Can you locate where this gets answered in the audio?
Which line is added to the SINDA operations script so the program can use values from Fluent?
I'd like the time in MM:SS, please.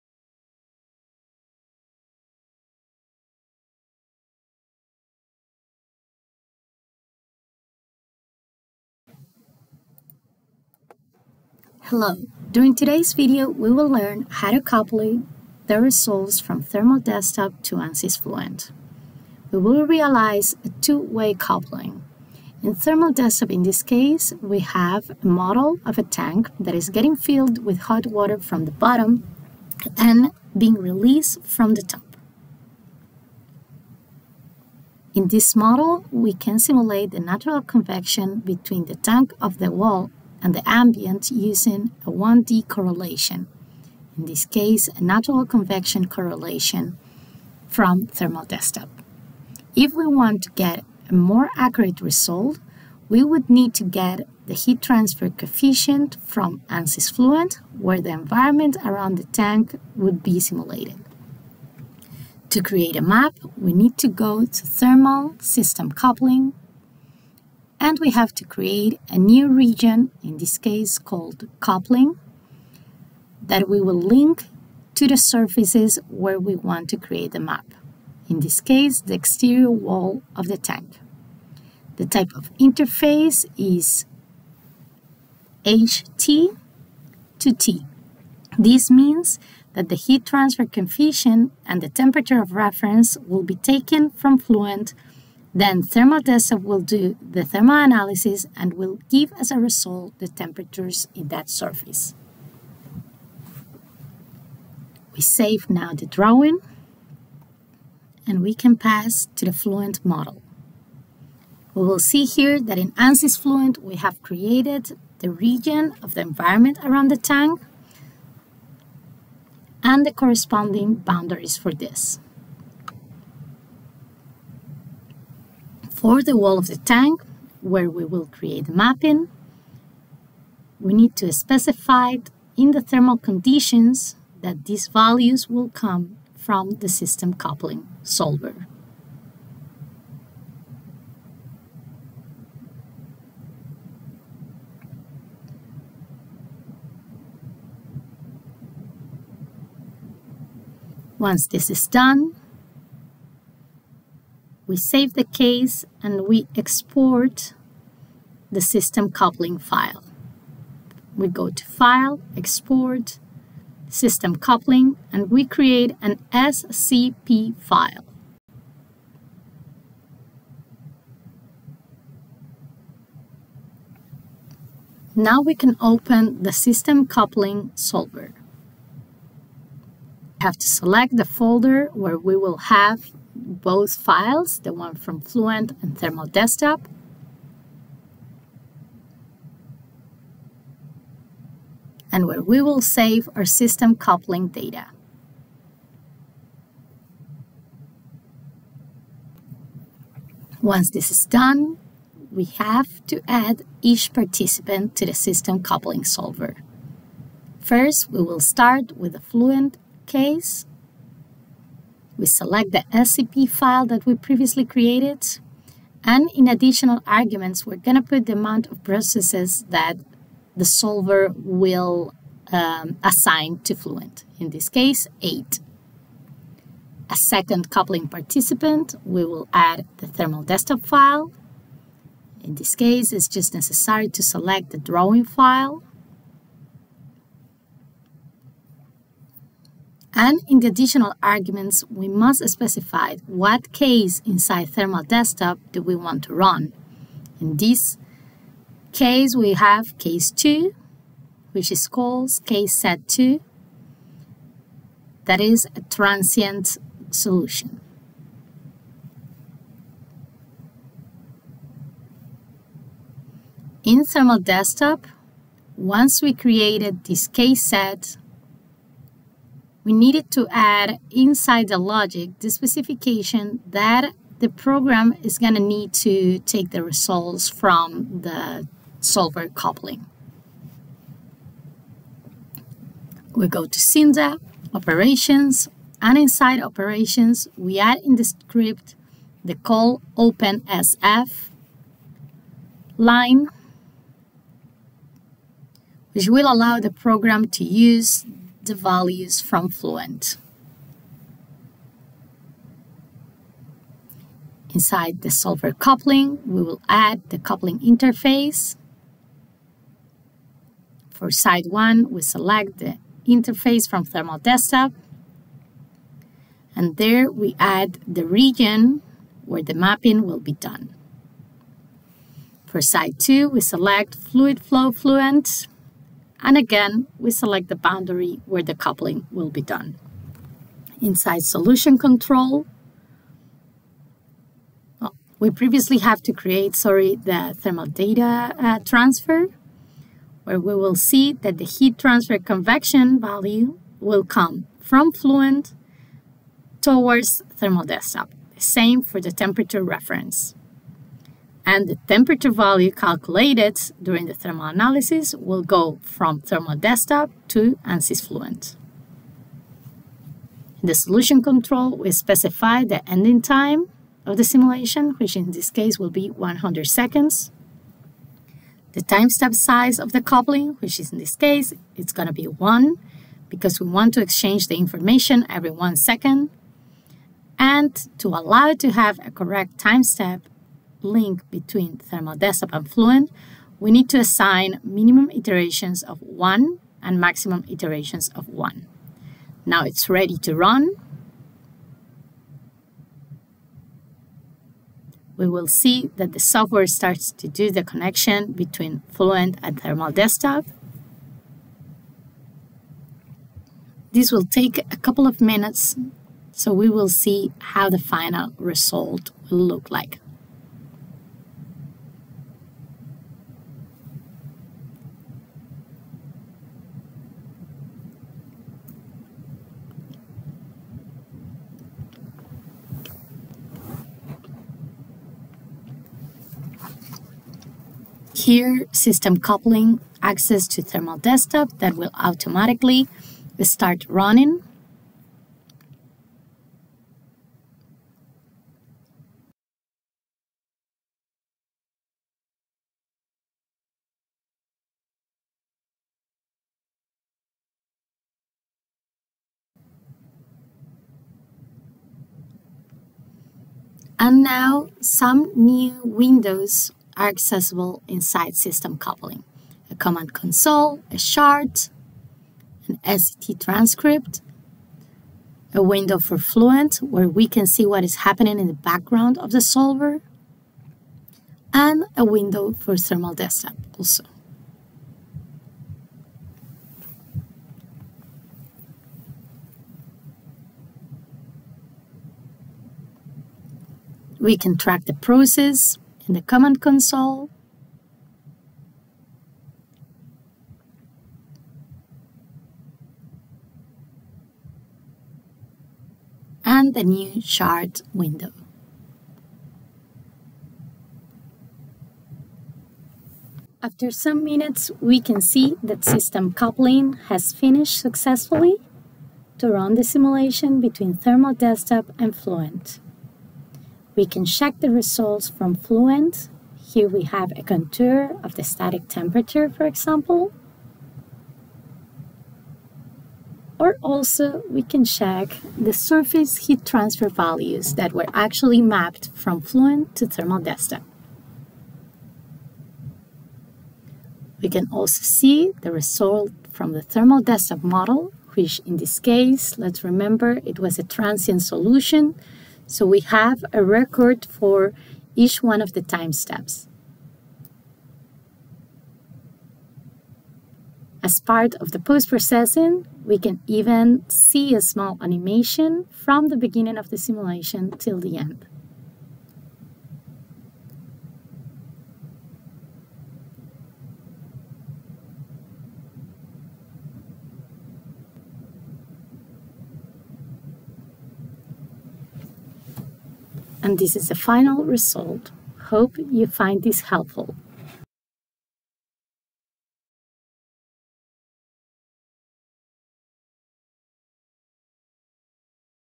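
04:49.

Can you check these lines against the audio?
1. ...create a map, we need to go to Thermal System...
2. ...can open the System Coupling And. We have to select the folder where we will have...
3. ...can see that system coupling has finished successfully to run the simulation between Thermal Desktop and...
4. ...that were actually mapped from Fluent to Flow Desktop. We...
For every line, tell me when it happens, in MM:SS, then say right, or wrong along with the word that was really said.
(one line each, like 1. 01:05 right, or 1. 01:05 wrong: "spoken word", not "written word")
1. 01:02 right
2. 02:55 wrong: "Solver", not "And"
3. 08:25 right
4. 08:47 wrong: "Thermal", not "Flow".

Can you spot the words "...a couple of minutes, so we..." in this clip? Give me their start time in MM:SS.
06:44.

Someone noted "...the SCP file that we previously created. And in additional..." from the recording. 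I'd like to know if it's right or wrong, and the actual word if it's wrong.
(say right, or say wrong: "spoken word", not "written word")
right.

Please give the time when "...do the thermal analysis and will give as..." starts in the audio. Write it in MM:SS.
01:36.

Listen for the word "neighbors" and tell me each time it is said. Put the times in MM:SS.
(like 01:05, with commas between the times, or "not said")
not said.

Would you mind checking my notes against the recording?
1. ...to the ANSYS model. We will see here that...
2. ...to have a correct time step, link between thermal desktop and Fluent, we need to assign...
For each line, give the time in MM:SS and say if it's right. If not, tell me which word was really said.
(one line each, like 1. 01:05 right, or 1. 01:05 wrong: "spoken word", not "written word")
1. 01:49 wrong: "Fluent", not "ANSYS"
2. 06:18 right.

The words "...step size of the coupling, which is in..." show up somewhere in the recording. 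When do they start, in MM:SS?
06:09.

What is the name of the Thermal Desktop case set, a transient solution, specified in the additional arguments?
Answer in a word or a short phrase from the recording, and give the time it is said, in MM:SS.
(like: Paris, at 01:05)
case set 2, at 04:12.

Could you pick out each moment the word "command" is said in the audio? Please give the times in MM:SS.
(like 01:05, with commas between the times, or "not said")
07:39, 08:06.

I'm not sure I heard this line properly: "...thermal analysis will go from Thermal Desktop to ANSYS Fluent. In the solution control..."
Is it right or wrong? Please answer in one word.
right.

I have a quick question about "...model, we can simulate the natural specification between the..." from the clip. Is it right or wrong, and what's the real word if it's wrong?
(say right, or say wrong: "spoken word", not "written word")
wrong: "convection", not "specification".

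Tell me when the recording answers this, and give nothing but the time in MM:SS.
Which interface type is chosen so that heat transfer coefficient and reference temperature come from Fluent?
01:25.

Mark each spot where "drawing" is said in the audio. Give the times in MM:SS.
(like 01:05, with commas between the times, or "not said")
01:46, 03:54.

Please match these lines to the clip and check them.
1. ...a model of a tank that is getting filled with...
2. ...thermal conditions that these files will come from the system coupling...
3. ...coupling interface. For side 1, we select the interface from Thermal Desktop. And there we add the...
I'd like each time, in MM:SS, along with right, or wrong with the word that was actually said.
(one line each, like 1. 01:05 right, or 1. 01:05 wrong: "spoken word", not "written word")
1. 00:25 right
2. 02:12 wrong: "values", not "files"
3. 05:07 right.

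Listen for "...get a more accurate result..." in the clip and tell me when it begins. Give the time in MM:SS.
00:50.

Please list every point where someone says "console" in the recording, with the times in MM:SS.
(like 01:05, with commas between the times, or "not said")
07:40, 08:06.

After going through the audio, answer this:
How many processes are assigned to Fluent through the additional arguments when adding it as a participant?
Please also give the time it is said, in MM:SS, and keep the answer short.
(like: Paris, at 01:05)
8, at 03:45.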